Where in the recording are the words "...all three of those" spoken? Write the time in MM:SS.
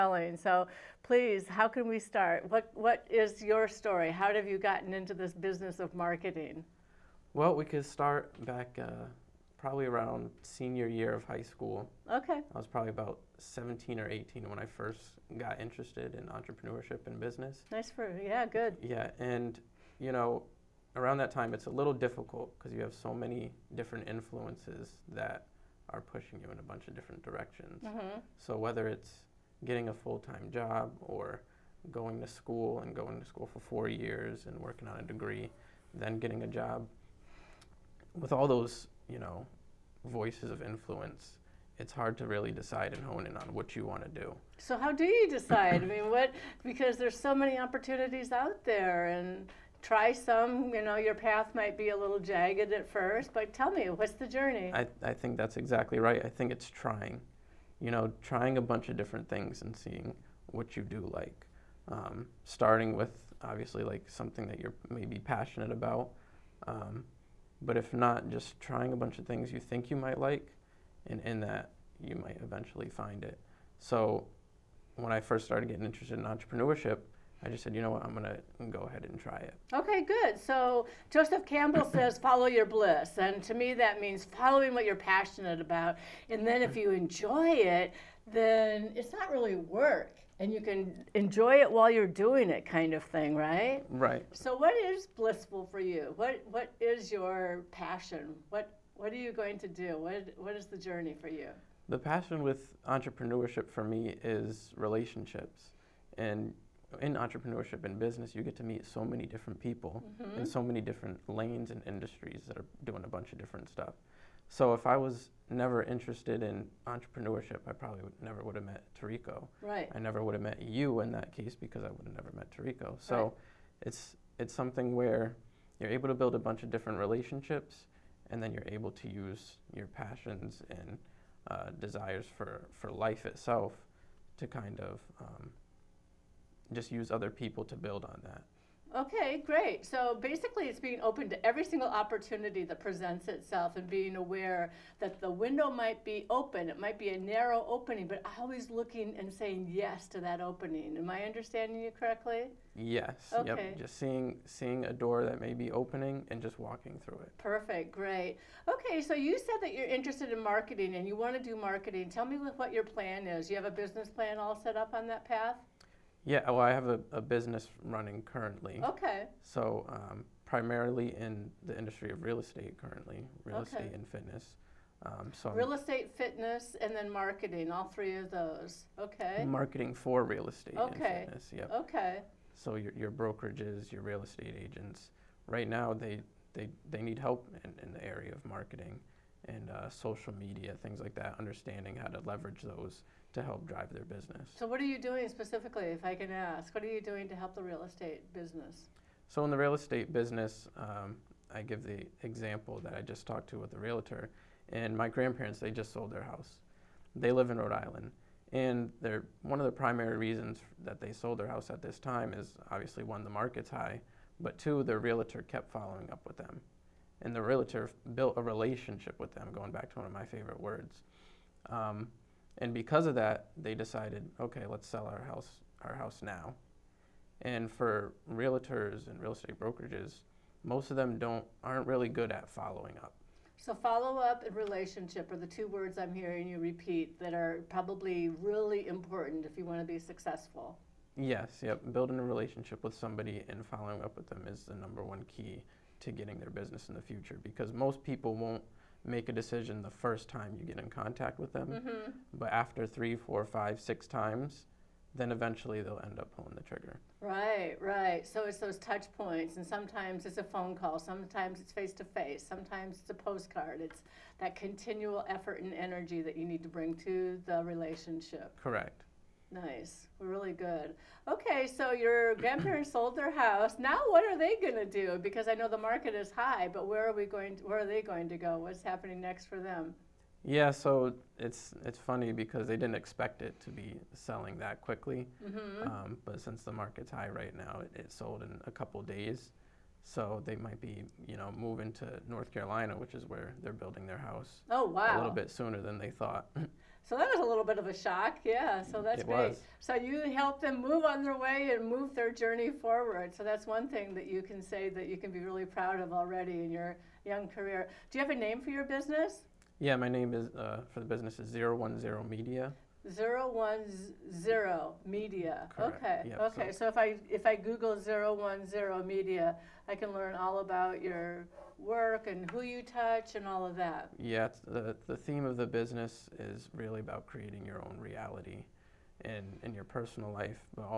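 02:57.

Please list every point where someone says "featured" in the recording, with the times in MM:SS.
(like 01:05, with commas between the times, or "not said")
not said.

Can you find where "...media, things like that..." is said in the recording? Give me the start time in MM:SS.
03:10.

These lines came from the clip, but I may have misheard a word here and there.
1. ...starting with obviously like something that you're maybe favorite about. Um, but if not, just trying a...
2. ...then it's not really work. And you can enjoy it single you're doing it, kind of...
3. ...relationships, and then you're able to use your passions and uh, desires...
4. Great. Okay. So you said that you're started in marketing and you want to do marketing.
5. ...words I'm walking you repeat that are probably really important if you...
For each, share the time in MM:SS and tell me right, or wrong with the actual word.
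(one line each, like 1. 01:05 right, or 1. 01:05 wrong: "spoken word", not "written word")
1. 01:02 wrong: "passionate", not "favorite"
2. 01:28 wrong: "while", not "single"
3. 02:06 right
4. 02:37 wrong: "interested", not "started"
5. 03:55 wrong: "hearing", not "walking".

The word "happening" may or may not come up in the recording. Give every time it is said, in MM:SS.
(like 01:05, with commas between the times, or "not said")
04:38.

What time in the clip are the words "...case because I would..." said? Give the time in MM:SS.
02:01.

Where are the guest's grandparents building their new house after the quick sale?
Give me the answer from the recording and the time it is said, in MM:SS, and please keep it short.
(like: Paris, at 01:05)
North Carolina, at 04:52.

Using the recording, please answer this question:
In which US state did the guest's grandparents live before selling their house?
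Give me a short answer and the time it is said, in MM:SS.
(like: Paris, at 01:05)
Rhode Island, at 03:27.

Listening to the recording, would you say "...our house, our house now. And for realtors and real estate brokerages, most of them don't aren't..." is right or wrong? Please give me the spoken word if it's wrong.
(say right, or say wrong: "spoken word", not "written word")
right.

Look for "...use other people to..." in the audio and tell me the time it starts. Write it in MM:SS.
02:16.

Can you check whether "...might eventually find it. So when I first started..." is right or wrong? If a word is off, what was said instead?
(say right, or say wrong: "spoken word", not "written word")
right.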